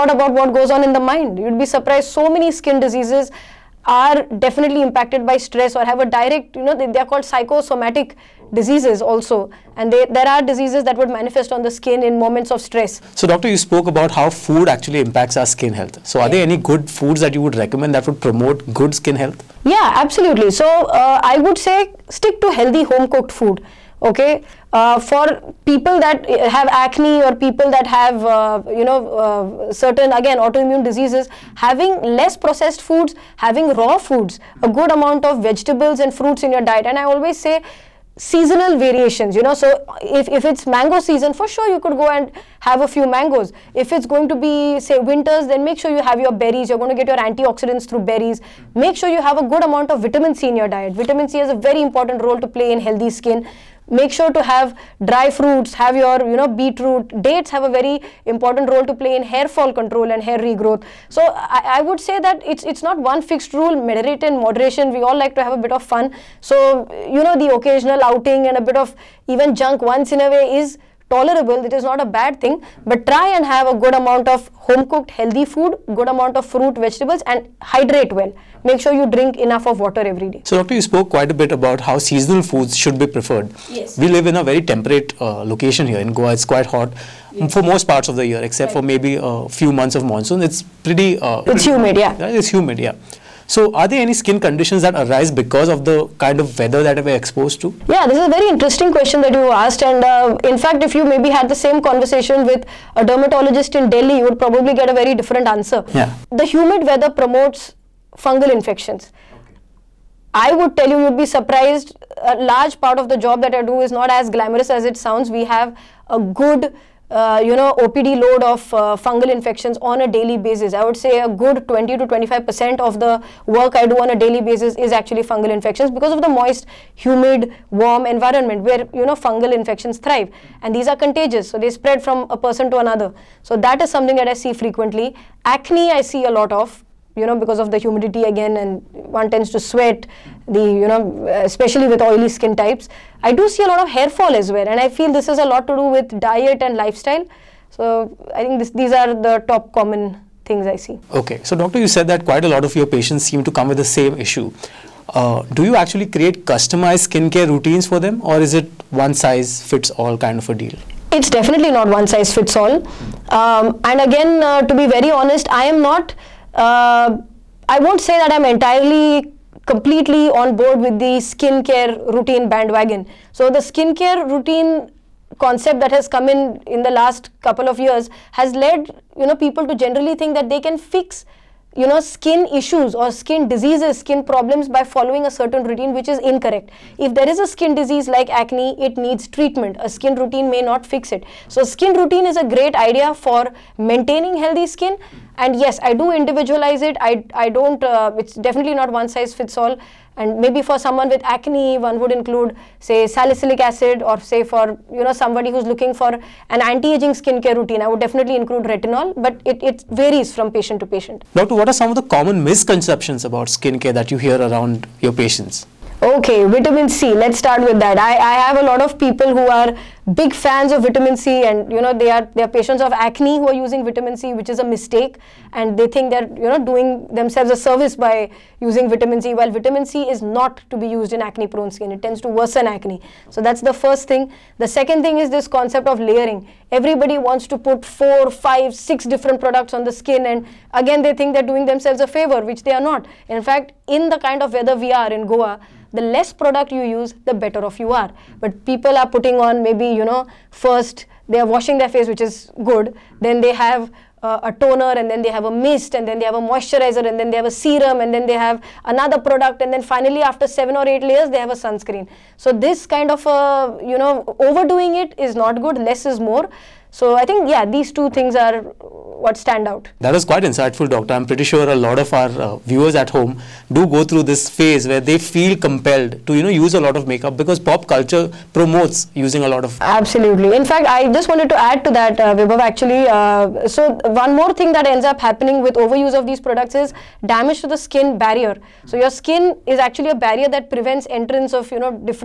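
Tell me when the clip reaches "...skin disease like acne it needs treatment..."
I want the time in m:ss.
3:07.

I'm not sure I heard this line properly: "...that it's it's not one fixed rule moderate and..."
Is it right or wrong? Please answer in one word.
right.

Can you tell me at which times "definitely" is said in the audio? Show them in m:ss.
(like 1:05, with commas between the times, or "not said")
0:04, 2:41, 3:18, 3:28.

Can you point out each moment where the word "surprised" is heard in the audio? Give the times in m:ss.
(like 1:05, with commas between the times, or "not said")
0:01, 1:51.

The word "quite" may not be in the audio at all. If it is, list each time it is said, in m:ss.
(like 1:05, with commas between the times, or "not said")
1:21, 1:26, 2:32, 4:30.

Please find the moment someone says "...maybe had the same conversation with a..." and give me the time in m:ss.
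1:41.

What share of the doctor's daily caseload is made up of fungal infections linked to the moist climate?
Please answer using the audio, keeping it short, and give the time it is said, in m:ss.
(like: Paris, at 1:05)
20 to 25 percent, at 2:01.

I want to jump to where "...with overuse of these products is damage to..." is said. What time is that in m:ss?
4:45.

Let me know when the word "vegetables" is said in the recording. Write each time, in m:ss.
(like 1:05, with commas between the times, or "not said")
0:35, 1:16.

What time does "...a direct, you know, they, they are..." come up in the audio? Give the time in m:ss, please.
0:05.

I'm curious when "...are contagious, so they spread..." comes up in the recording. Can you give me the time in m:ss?
2:10.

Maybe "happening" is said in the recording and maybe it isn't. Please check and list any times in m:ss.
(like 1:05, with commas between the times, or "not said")
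4:45.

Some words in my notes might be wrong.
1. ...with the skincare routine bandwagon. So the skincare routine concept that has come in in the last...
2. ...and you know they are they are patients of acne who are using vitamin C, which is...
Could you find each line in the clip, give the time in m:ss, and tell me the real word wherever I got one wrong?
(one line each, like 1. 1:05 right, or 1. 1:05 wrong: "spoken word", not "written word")
1. 2:50 right
2. 3:41 right.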